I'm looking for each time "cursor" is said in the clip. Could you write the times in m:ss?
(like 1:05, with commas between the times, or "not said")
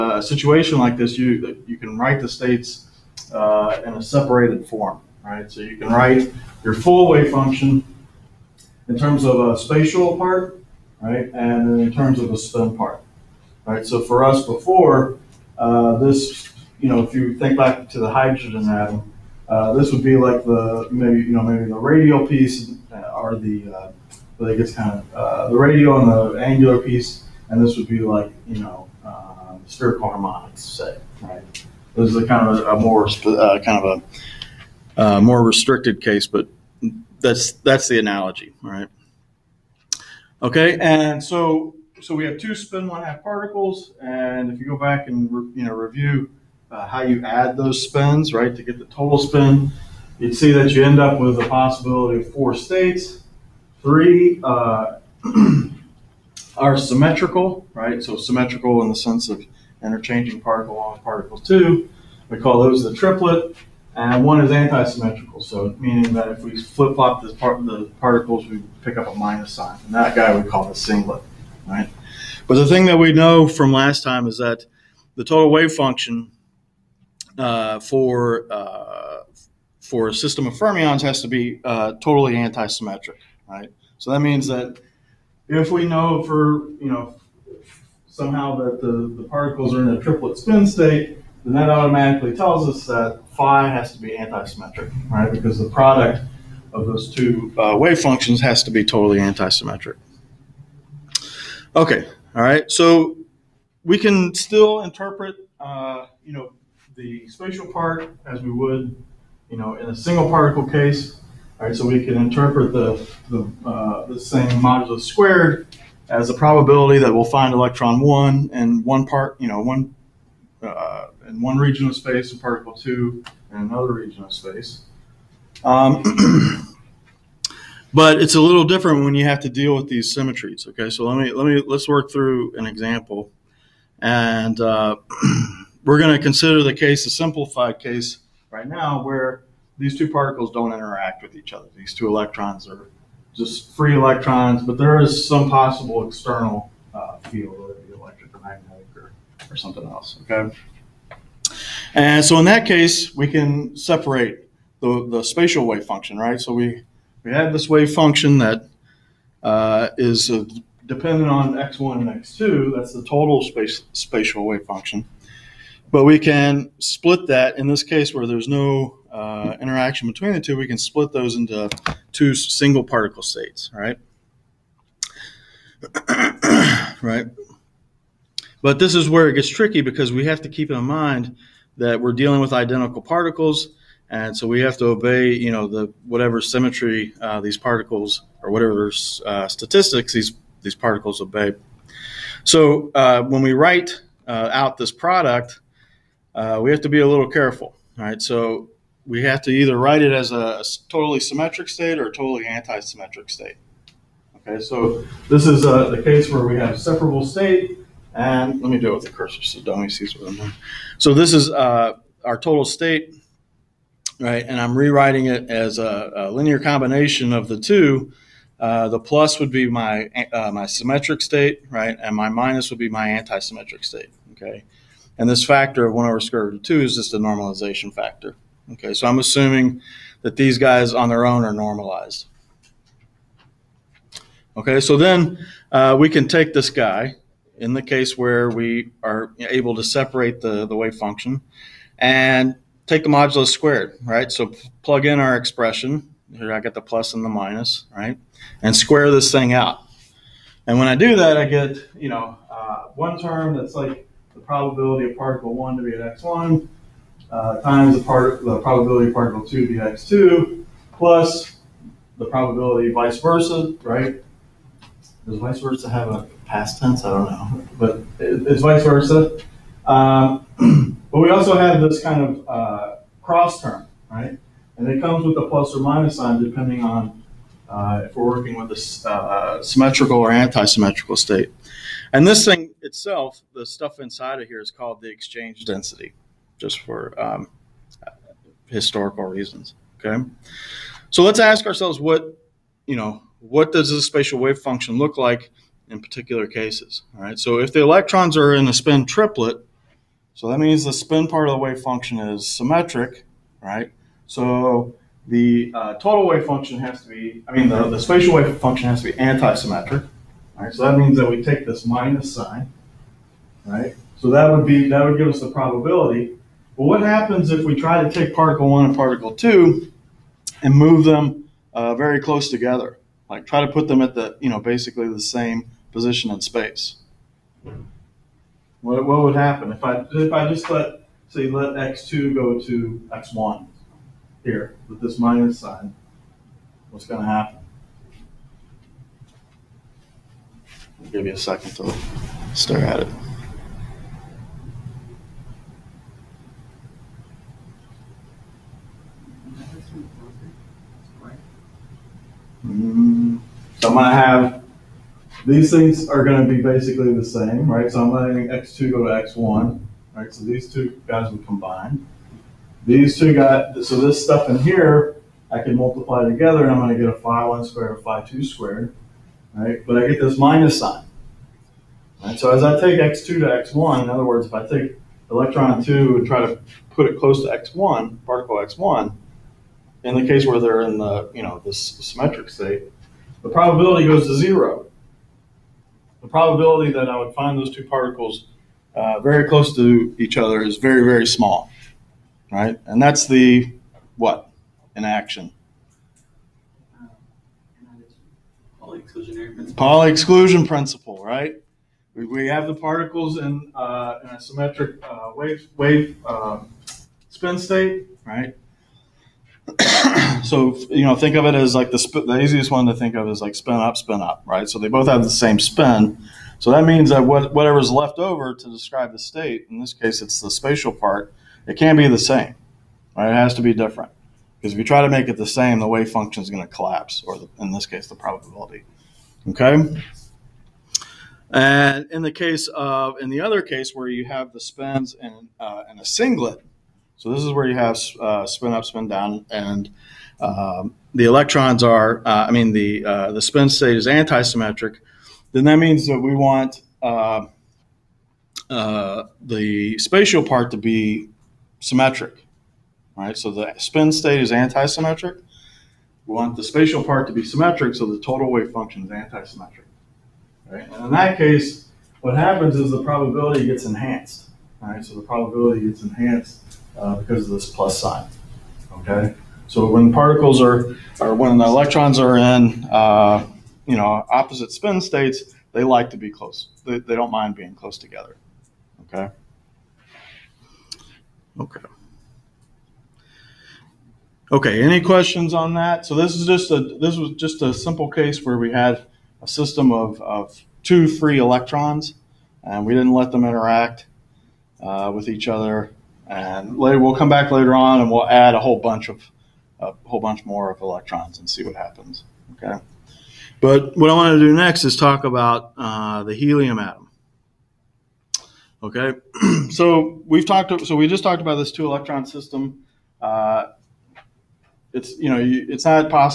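3:29.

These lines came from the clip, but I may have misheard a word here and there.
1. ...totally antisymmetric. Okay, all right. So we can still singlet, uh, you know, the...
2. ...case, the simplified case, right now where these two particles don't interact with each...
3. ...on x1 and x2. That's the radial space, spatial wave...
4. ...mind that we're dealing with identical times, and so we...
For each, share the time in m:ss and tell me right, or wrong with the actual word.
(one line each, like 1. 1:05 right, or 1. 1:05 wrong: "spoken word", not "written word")
1. 1:38 wrong: "interpret", not "singlet"
2. 2:16 right
3. 2:41 wrong: "total", not "radial"
4. 3:00 wrong: "particles", not "times".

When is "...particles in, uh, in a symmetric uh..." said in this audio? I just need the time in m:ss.
6:42.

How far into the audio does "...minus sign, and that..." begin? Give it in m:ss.
1:09.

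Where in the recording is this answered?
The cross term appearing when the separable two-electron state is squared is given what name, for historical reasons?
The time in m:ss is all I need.
4:45.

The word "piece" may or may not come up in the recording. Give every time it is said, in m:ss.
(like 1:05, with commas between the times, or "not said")
0:22, 0:26.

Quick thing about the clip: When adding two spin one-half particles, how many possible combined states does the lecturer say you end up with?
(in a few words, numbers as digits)
4.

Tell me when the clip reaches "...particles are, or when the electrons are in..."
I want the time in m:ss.
7:50.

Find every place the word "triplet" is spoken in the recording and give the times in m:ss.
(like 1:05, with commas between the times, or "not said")
1:02, 1:29, 4:59.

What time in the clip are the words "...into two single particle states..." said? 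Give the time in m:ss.
2:51.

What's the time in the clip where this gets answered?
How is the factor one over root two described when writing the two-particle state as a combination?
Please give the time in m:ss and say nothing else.
3:47.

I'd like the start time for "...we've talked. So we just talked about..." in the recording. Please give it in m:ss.
8:30.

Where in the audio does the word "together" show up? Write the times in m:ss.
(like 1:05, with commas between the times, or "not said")
5:22, 6:06, 7:57.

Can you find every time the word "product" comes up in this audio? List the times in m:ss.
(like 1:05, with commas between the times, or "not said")
1:35, 3:14.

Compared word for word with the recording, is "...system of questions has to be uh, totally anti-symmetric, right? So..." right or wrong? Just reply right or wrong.
wrong.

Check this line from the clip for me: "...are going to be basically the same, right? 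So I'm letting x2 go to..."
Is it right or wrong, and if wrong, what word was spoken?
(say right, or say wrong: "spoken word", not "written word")
right.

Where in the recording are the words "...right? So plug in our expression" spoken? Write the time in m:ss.
4:04.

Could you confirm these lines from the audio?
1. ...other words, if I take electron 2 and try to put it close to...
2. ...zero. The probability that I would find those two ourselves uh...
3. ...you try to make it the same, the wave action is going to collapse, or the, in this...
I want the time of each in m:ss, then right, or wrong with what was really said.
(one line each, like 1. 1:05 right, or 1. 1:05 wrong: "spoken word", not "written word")
1. 6:14 right
2. 6:24 wrong: "particles", not "ourselves"
3. 7:04 wrong: "function", not "action".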